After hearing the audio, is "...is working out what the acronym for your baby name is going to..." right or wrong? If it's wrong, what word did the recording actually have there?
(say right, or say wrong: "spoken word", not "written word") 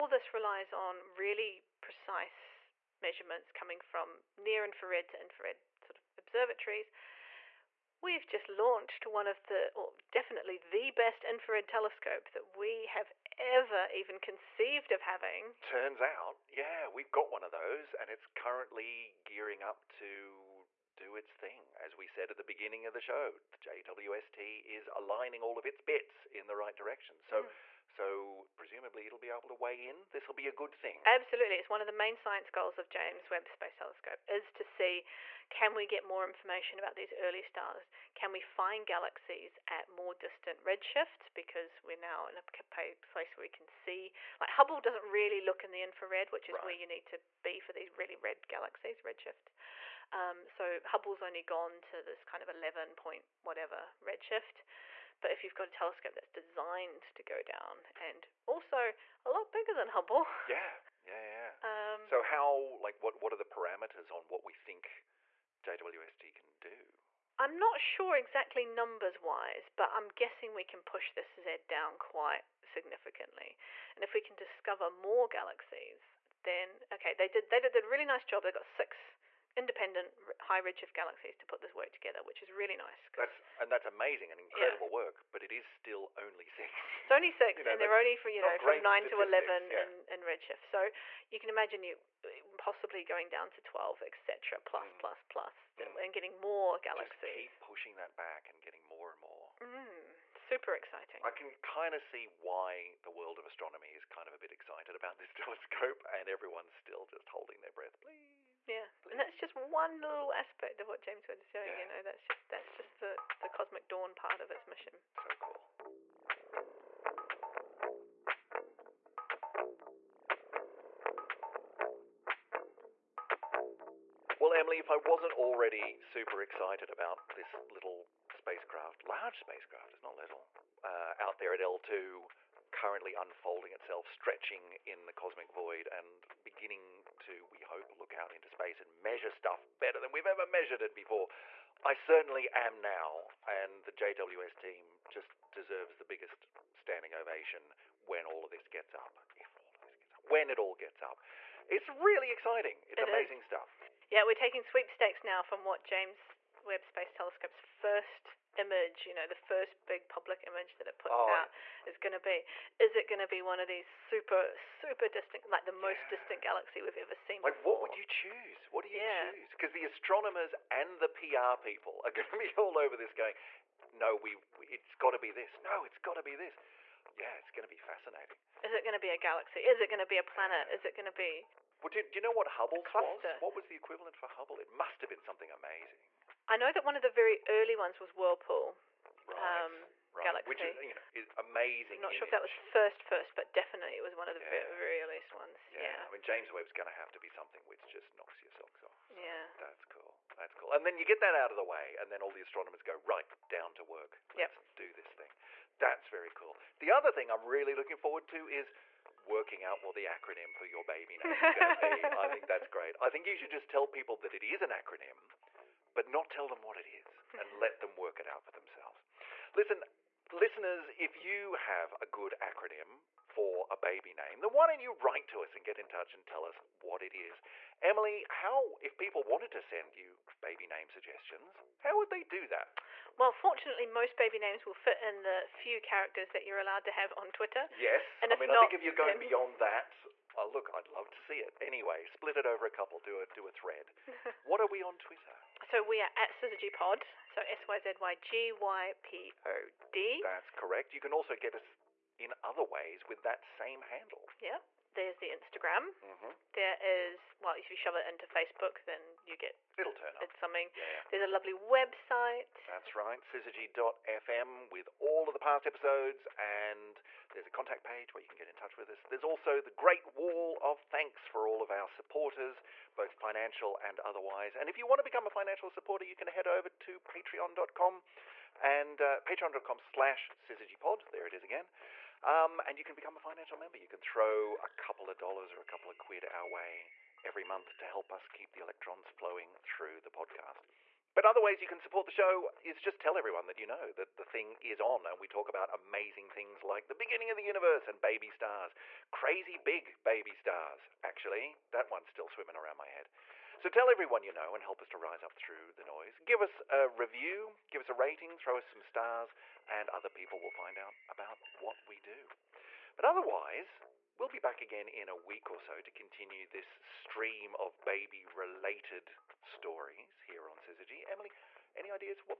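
right.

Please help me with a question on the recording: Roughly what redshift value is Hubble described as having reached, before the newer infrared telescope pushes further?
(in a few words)
11.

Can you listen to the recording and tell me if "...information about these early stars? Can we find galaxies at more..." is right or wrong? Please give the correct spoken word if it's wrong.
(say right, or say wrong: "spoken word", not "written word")
right.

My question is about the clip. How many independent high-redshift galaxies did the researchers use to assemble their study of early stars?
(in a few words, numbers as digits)
6.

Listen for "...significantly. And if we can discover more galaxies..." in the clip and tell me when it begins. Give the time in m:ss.
1:12.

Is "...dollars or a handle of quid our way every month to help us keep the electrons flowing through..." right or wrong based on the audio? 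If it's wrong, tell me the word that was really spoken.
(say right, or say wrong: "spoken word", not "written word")
wrong: "couple", not "handle".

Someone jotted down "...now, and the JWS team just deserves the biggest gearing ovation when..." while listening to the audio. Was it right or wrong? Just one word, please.
wrong.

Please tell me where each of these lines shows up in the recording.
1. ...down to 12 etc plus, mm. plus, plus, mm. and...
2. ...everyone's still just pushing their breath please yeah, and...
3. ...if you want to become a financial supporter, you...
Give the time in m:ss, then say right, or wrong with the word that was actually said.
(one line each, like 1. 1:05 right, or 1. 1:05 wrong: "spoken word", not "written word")
1. 1:33 right
2. 1:46 wrong: "holding", not "pushing"
3. 4:34 right.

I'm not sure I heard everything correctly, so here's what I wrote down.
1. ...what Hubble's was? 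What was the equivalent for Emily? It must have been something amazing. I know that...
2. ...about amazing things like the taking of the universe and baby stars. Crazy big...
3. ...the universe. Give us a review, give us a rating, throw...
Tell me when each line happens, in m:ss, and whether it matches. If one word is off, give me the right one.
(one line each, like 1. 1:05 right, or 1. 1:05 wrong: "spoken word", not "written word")
1. 3:02 wrong: "Hubble", not "Emily"
2. 4:55 wrong: "beginning", not "taking"
3. 5:05 wrong: "noise", not "universe".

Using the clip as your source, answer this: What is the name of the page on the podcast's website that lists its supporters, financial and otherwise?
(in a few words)
Great wall of thanks.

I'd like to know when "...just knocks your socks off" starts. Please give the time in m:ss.
3:17.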